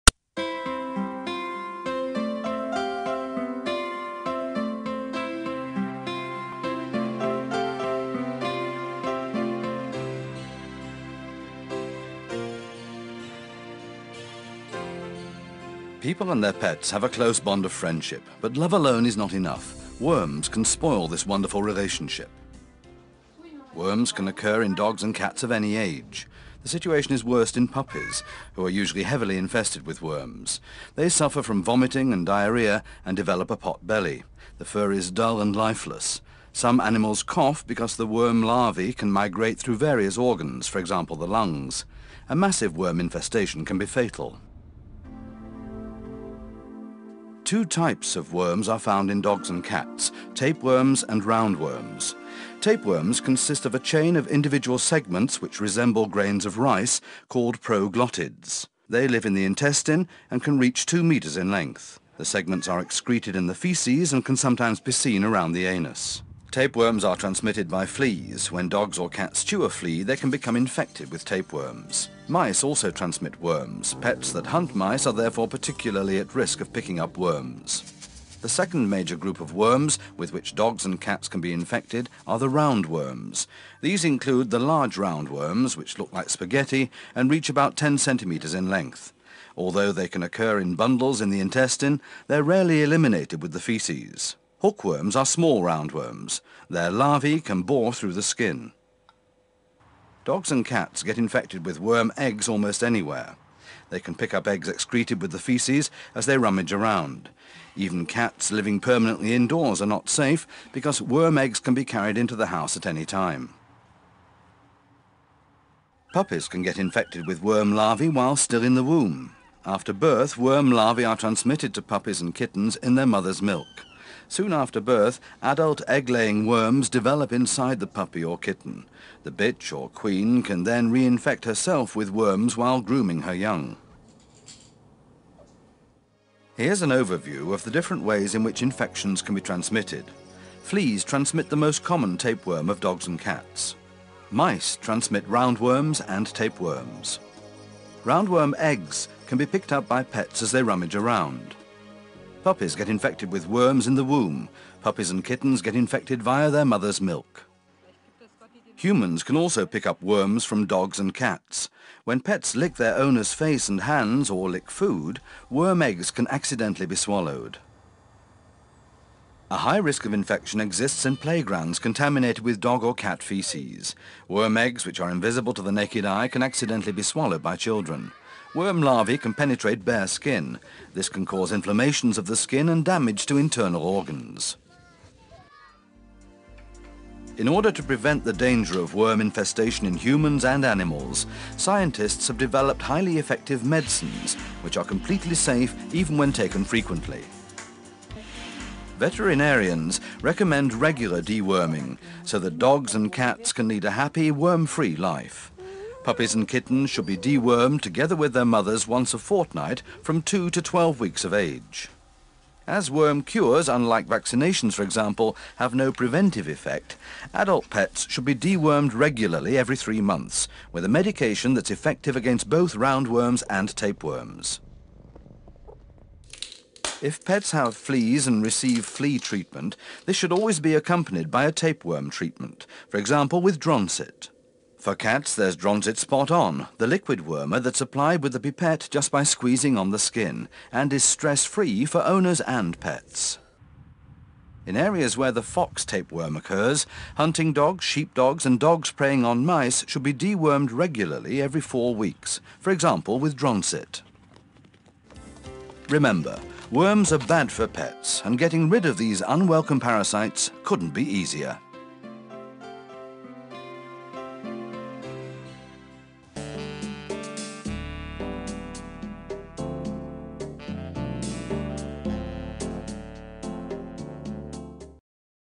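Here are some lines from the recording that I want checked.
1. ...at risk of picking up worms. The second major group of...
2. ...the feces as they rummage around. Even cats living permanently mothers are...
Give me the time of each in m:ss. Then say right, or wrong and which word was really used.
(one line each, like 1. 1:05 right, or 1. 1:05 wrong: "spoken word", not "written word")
1. 1:16 right
2. 1:45 wrong: "indoors", not "mothers".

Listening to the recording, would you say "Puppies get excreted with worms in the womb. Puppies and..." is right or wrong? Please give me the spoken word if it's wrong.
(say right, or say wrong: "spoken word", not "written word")
wrong: "infected", not "excreted".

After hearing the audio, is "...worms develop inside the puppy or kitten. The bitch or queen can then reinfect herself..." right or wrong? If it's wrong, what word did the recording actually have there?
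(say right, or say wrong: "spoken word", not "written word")
right.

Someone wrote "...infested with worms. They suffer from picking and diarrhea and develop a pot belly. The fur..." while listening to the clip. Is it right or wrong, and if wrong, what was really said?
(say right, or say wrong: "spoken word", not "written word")
wrong: "vomiting", not "picking".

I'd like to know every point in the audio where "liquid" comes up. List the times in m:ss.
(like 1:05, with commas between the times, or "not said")
3:56.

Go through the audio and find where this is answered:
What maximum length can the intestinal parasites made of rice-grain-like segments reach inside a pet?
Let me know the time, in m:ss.
1:00.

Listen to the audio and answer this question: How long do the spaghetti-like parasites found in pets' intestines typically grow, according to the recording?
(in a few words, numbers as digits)
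10 centimetres.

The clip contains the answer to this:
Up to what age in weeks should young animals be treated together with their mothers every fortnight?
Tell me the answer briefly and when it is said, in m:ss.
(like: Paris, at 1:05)
12 weeks, at 3:30.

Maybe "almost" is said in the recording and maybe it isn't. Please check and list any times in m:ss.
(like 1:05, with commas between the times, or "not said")
1:42.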